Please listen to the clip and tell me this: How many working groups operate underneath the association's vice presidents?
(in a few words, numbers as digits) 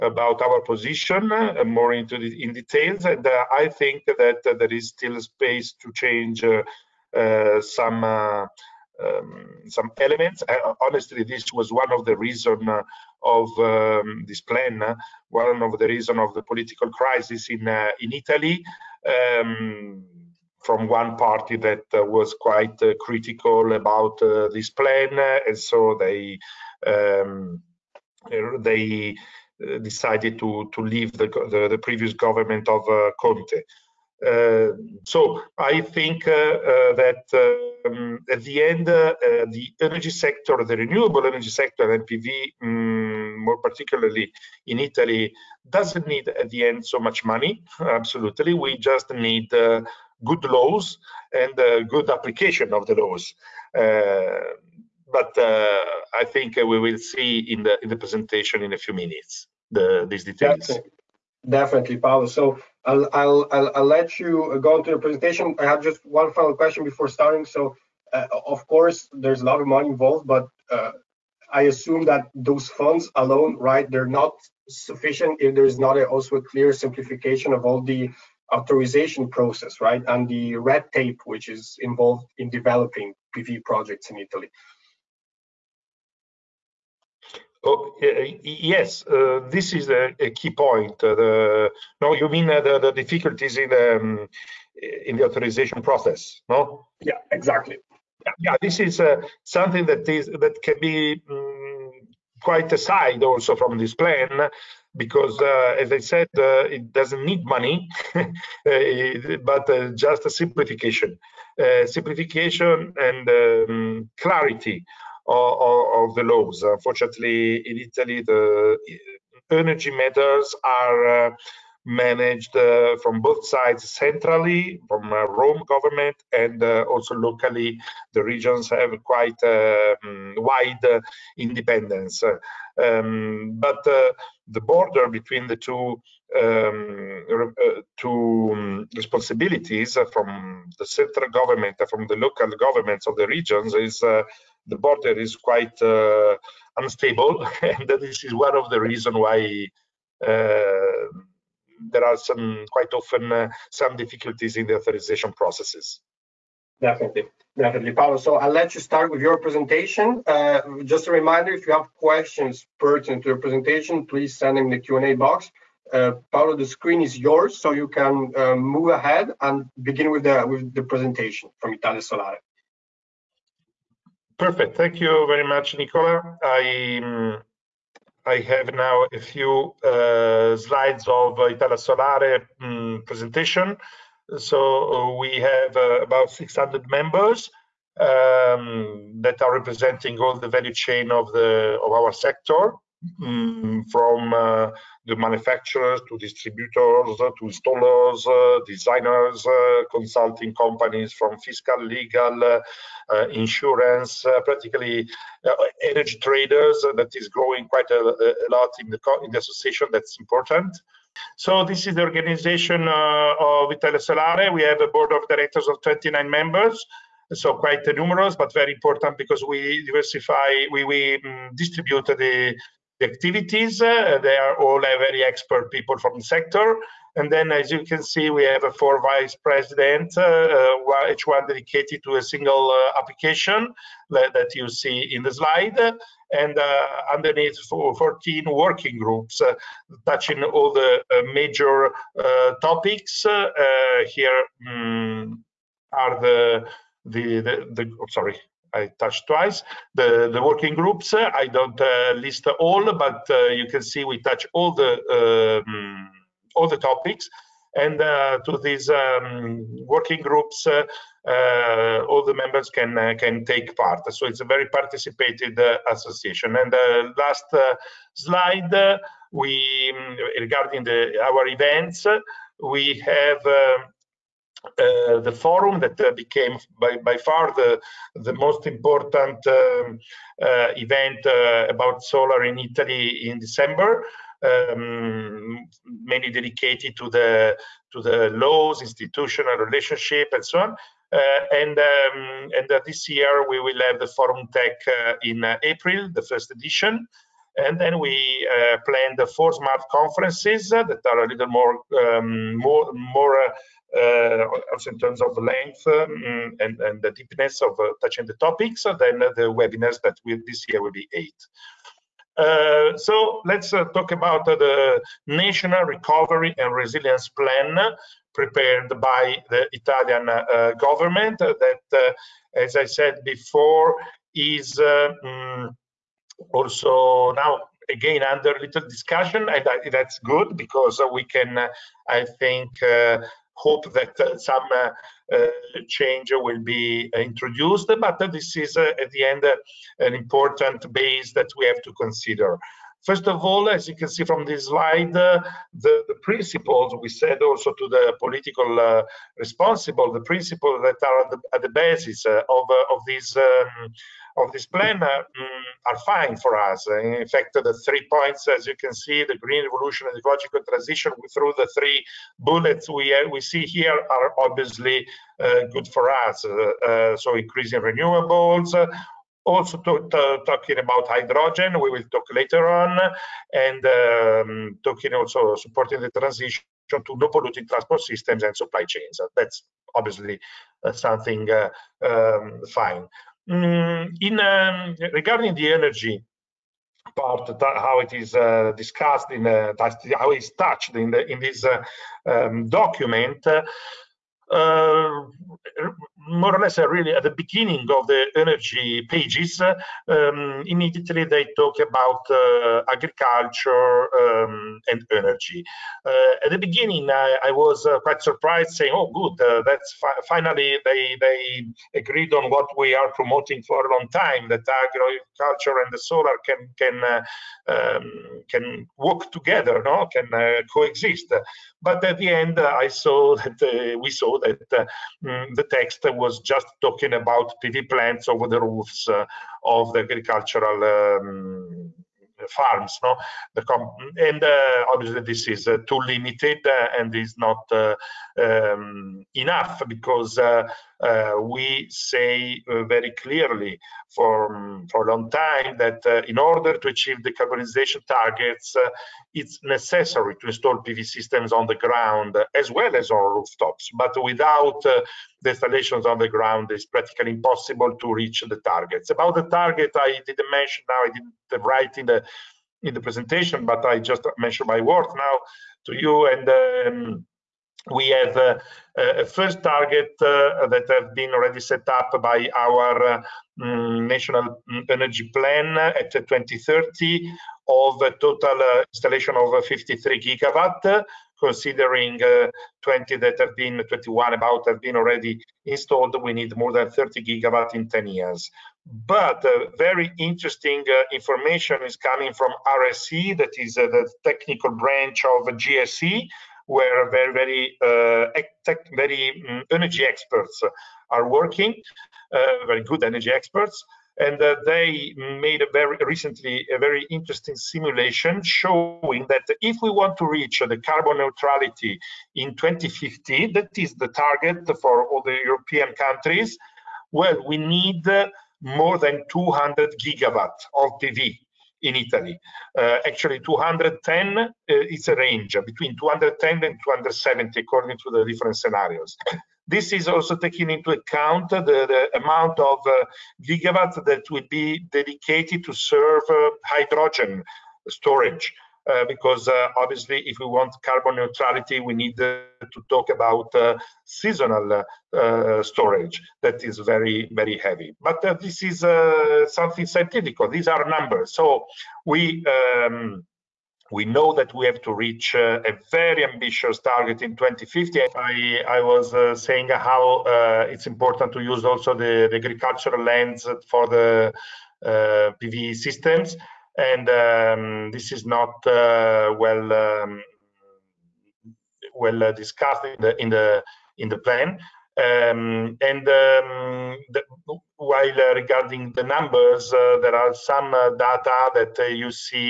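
14.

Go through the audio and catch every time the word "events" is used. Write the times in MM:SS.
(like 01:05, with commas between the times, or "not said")
04:31, 04:40.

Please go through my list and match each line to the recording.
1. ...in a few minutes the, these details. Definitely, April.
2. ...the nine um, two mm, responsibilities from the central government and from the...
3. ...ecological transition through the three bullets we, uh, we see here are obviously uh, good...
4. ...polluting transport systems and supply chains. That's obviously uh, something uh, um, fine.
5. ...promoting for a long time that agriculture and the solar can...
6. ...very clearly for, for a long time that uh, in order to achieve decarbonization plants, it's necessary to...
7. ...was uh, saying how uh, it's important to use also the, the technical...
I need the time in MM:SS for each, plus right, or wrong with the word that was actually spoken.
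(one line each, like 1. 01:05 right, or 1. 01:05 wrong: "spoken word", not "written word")
1. 00:58 wrong: "Paolo", not "April"
2. 02:15 wrong: "two", not "nine"
3. 06:00 right
4. 06:17 right
5. 06:53 right
6. 07:22 wrong: "targets", not "plants"
7. 09:18 wrong: "agricultural", not "technical".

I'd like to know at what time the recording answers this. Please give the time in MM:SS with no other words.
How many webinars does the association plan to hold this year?
05:11.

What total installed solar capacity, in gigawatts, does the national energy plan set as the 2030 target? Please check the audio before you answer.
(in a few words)
53 gigawatt.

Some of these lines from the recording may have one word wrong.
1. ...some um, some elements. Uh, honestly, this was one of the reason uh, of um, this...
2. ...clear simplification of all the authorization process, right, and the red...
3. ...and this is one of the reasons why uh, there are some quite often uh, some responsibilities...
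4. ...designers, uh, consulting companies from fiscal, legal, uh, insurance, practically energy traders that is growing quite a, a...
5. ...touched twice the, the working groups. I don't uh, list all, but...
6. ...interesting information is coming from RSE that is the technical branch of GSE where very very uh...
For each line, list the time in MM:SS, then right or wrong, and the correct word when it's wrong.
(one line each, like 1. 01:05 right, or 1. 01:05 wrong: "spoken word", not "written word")
1. 00:07 right
2. 01:16 right
3. 02:27 wrong: "difficulties", not "responsibilities"
4. 03:18 right
5. 04:08 right
6. 08:10 right.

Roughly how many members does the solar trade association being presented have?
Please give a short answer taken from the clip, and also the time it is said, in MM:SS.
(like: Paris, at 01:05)
600, at 03:06.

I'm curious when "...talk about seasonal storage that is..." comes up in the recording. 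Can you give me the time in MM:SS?
09:02.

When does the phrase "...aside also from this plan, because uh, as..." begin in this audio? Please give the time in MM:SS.
01:42.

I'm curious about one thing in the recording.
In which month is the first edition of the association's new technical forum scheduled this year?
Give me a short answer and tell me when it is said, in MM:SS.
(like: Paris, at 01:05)
April, at 04:55.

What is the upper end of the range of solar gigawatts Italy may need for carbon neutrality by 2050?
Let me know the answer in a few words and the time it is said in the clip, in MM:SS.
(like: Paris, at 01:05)
270, at 08:46.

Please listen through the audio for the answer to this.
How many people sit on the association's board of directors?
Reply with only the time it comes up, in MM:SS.
03:35.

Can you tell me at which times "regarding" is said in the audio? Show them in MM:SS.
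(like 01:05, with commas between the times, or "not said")
04:30, 06:25, 09:38.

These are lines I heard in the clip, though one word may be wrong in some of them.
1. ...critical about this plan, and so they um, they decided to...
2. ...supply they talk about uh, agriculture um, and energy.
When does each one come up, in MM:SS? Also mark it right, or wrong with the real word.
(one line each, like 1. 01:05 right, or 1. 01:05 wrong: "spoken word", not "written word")
1. 00:22 right
2. 06:40 wrong: "immediately", not "supply".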